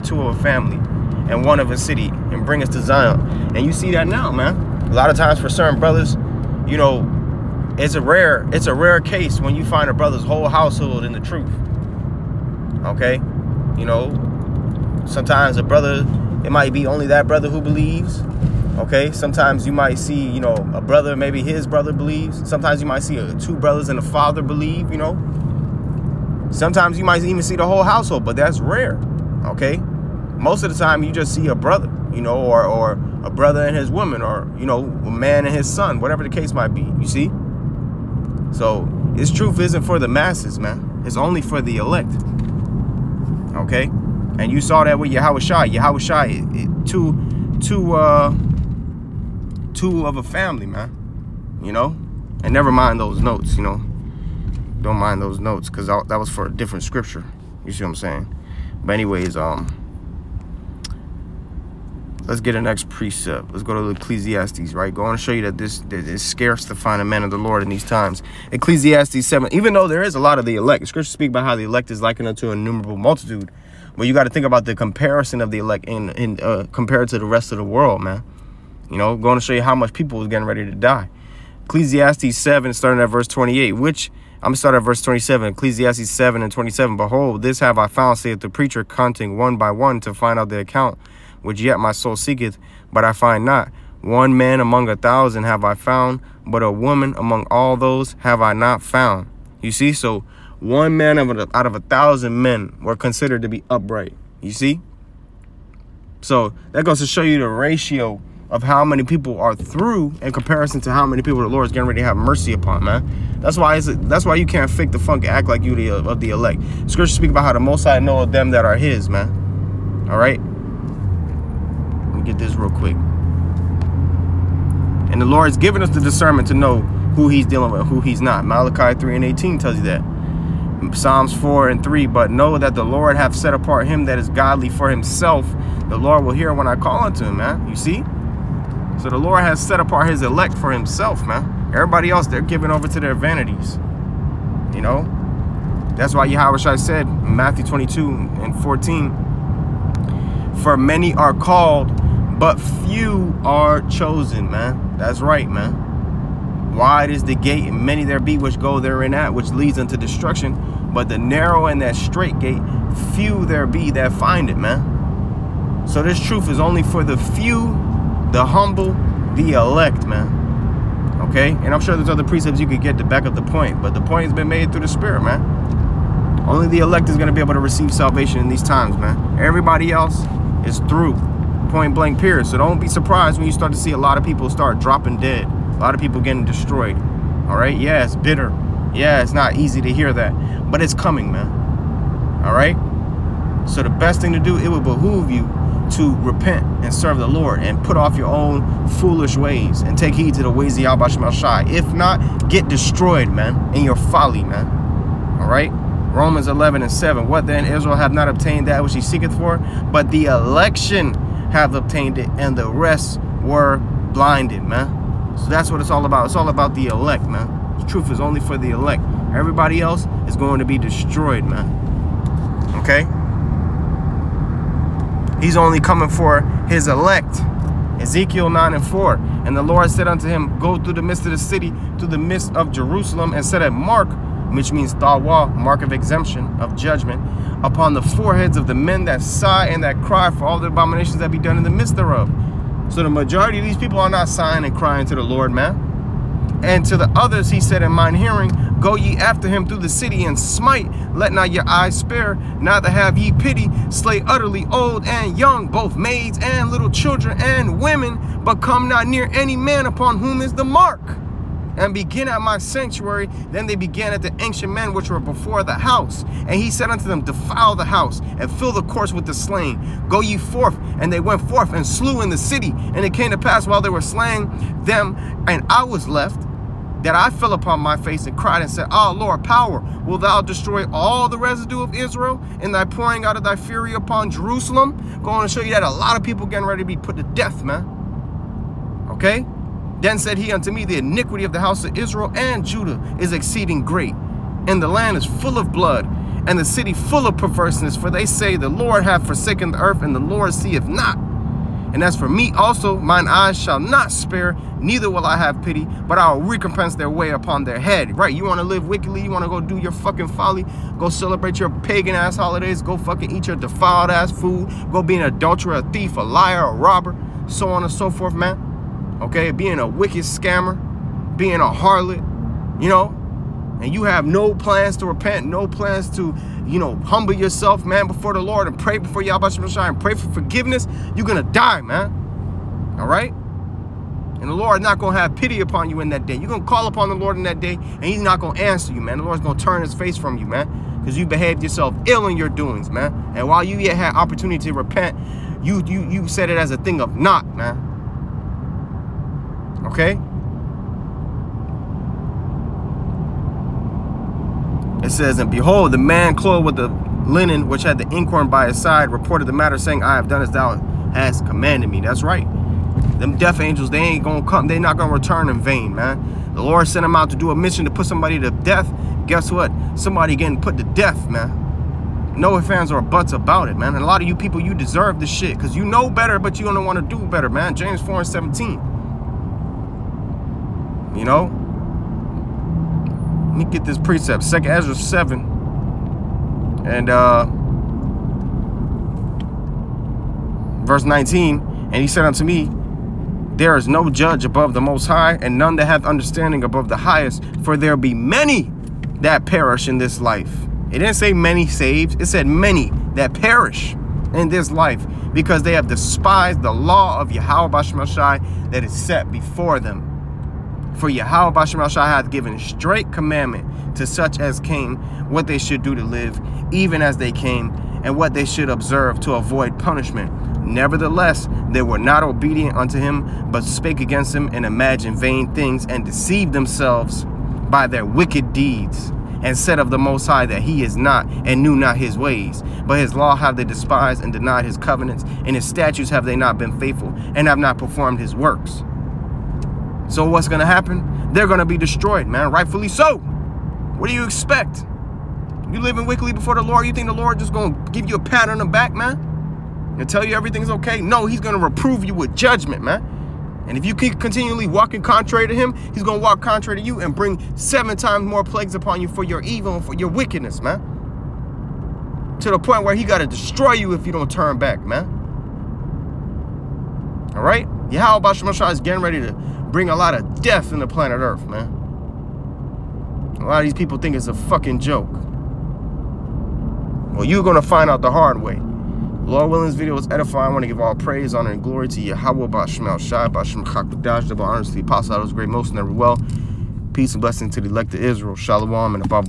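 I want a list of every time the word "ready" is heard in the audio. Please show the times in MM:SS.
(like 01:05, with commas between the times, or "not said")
01:20, 01:51, 04:46, 07:49.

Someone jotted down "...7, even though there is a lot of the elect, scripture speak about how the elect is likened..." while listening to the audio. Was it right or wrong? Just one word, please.
right.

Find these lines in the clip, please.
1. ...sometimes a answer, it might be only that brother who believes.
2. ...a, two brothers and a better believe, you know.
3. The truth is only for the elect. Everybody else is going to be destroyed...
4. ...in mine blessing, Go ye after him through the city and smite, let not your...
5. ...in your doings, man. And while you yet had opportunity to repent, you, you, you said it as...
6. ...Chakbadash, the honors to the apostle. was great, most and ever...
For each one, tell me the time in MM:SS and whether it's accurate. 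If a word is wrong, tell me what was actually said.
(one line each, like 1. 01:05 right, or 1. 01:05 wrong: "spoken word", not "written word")
1. 00:15 wrong: "brother", not "answer"
2. 00:23 wrong: "father", not "better"
3. 03:37 right
4. 04:07 wrong: "hearing", not "blessing"
5. 05:42 right
6. 08:03 right.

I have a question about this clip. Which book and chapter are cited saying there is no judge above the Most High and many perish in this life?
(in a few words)
Second Esdras 7.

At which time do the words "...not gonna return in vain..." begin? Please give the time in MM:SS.
06:04.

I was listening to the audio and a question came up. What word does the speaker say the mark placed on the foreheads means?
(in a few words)
Tawa.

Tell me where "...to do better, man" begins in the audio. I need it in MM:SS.
06:17.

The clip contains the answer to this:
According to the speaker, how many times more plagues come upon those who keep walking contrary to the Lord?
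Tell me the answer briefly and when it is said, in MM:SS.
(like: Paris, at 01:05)
7, at 07:37.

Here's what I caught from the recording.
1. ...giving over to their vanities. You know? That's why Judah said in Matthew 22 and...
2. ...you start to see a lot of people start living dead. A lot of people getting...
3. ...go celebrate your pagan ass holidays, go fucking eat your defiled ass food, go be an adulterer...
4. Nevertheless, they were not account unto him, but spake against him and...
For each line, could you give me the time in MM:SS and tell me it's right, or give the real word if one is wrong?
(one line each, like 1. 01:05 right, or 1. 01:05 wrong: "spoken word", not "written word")
1. 02:22 wrong: "Yahweh", not "Judah"
2. 03:03 wrong: "dropping", not "living"
3. 05:10 right
4. 07:00 wrong: "obedient", not "account".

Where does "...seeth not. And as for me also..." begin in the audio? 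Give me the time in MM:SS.
05:00.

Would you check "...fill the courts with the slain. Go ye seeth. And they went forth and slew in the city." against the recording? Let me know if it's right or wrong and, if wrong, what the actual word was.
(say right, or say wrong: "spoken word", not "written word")
wrong: "forth", not "seeth".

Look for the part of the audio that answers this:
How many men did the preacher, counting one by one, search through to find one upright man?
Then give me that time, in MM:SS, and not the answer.
01:34.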